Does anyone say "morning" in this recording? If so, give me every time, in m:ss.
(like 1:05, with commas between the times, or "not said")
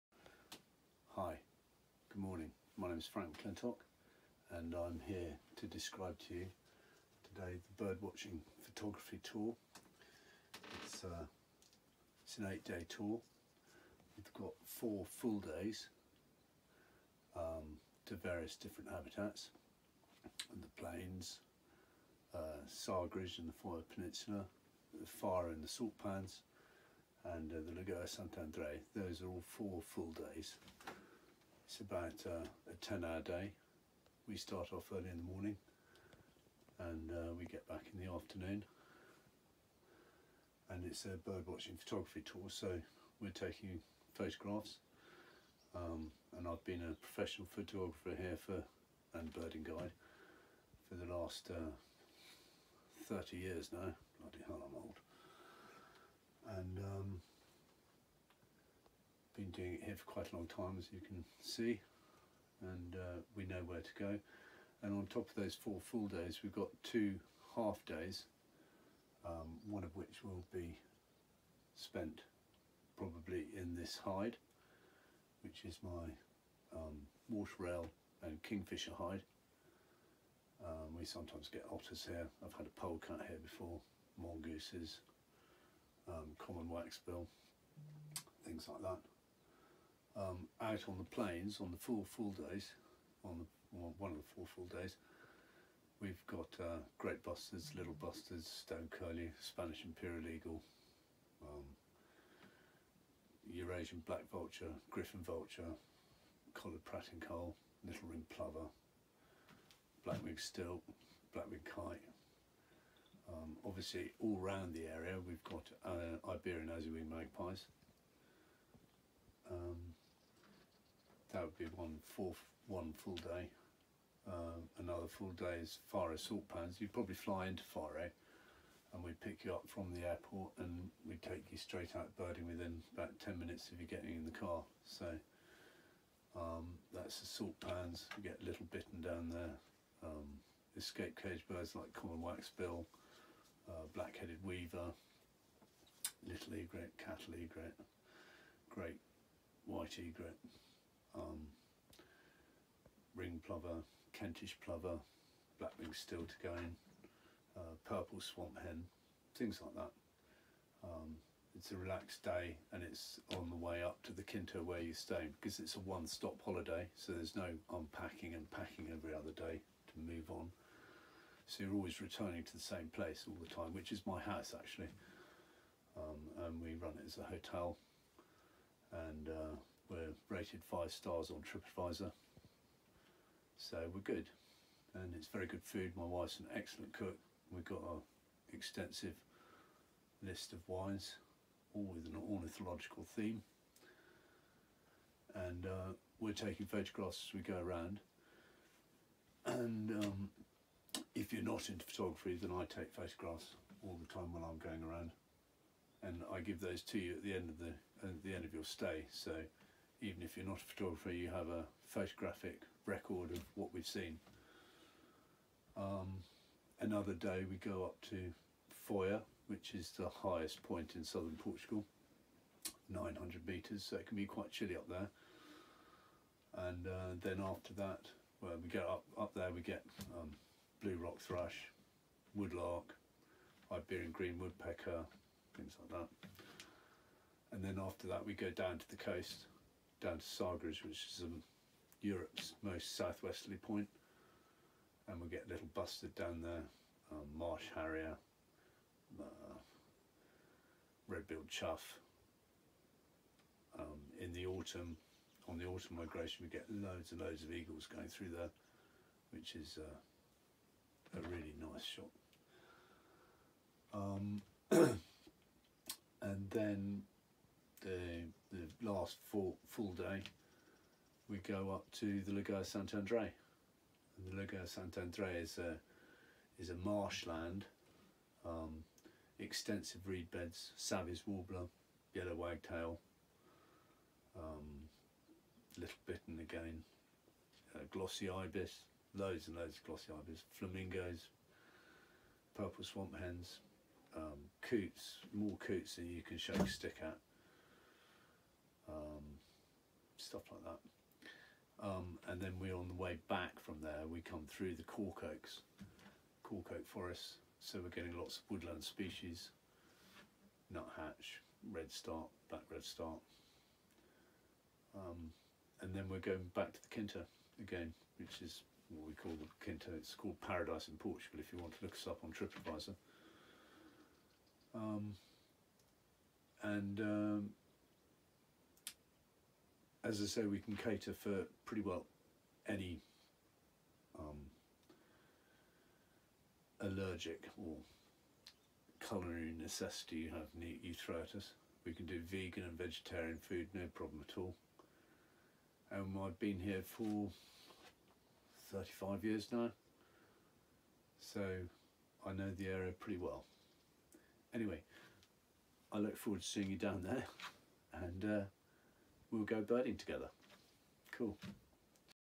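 0:02, 0:35.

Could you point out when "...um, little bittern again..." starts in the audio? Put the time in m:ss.
4:44.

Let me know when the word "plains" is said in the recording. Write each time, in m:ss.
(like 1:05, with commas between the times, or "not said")
0:20, 1:31.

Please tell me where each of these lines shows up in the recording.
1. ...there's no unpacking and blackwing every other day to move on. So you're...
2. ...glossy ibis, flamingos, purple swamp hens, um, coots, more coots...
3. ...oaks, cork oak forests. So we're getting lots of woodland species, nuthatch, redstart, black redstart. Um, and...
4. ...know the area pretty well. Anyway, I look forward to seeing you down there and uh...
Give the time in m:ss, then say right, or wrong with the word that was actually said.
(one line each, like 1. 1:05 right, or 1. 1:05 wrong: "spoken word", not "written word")
1. 2:47 wrong: "packing", not "blackwing"
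2. 4:49 right
3. 5:05 right
4. 5:52 right.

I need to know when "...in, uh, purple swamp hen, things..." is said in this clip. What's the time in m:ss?
2:36.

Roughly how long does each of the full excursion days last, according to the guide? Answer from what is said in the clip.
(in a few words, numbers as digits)
10 hours.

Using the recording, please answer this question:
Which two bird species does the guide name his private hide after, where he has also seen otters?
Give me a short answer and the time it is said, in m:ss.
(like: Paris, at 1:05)
Water rail and kingfisher, at 1:17.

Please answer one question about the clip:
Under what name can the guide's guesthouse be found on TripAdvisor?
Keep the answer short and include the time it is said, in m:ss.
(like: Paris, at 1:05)
Paradise in Portugal, at 5:20.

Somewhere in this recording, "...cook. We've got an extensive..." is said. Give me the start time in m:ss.
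3:06.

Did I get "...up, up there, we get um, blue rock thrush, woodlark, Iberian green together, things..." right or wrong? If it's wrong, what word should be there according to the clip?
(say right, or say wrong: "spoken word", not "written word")
wrong: "woodpecker", not "together".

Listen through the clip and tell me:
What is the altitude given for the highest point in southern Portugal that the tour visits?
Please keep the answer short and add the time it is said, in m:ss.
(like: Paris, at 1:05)
900 metres, at 3:42.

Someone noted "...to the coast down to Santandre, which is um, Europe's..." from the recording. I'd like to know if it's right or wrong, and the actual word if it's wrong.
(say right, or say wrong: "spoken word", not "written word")
wrong: "Sagres", not "Santandre".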